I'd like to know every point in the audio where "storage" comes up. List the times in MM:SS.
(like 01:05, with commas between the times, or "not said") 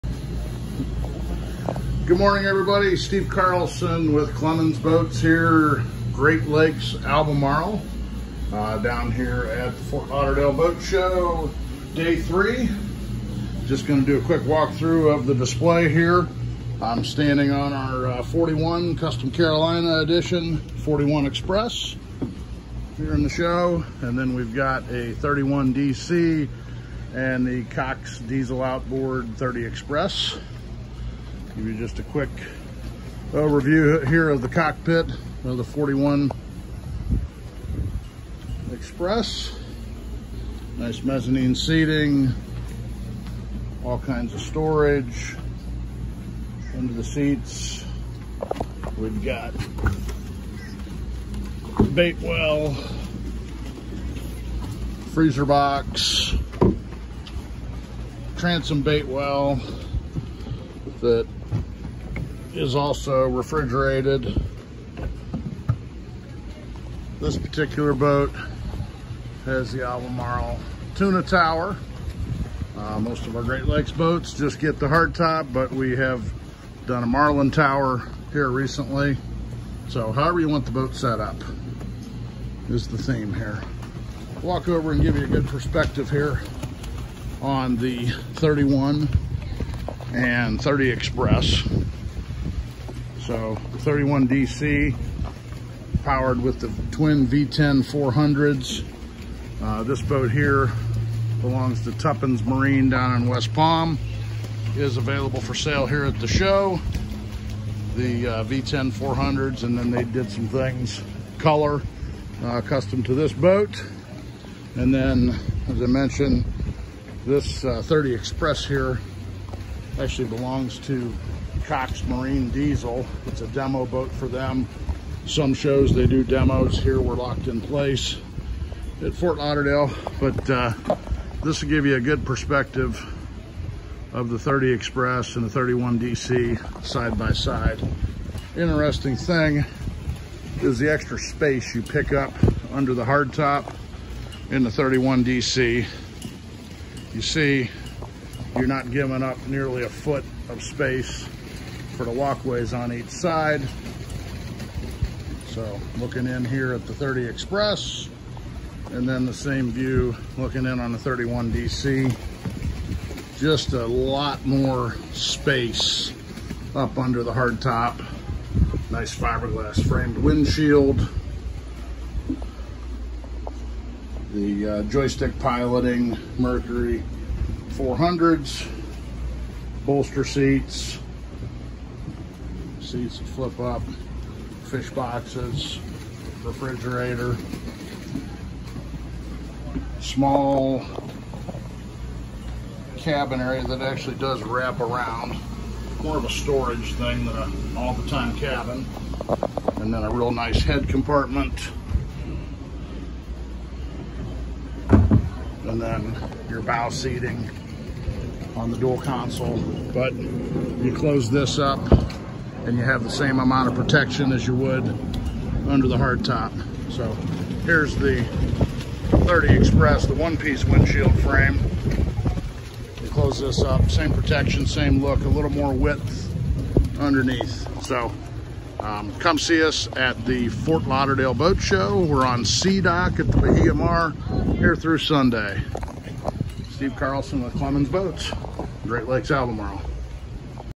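00:44, 03:16.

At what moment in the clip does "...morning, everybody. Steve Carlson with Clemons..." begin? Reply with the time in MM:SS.
00:02.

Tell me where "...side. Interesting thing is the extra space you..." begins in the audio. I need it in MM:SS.
02:17.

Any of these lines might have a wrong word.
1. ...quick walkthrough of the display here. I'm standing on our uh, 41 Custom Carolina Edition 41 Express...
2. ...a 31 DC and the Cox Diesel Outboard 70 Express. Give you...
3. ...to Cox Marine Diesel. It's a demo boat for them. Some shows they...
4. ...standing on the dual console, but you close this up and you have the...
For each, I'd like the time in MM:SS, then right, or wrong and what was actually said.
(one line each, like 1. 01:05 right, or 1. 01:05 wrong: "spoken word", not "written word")
1. 00:14 right
2. 00:24 wrong: "30", not "70"
3. 02:00 right
4. 03:26 wrong: "seating", not "standing".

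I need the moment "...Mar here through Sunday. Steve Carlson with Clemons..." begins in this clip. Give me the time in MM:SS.
03:53.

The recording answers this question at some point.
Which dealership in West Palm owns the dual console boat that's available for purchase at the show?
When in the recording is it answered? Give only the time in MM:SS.
01:41.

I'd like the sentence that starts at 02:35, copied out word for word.
So looking in here at the 30 Express and then the same view looking in on the 31 DC.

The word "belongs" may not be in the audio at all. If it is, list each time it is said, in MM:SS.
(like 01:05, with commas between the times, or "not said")
01:41, 02:00.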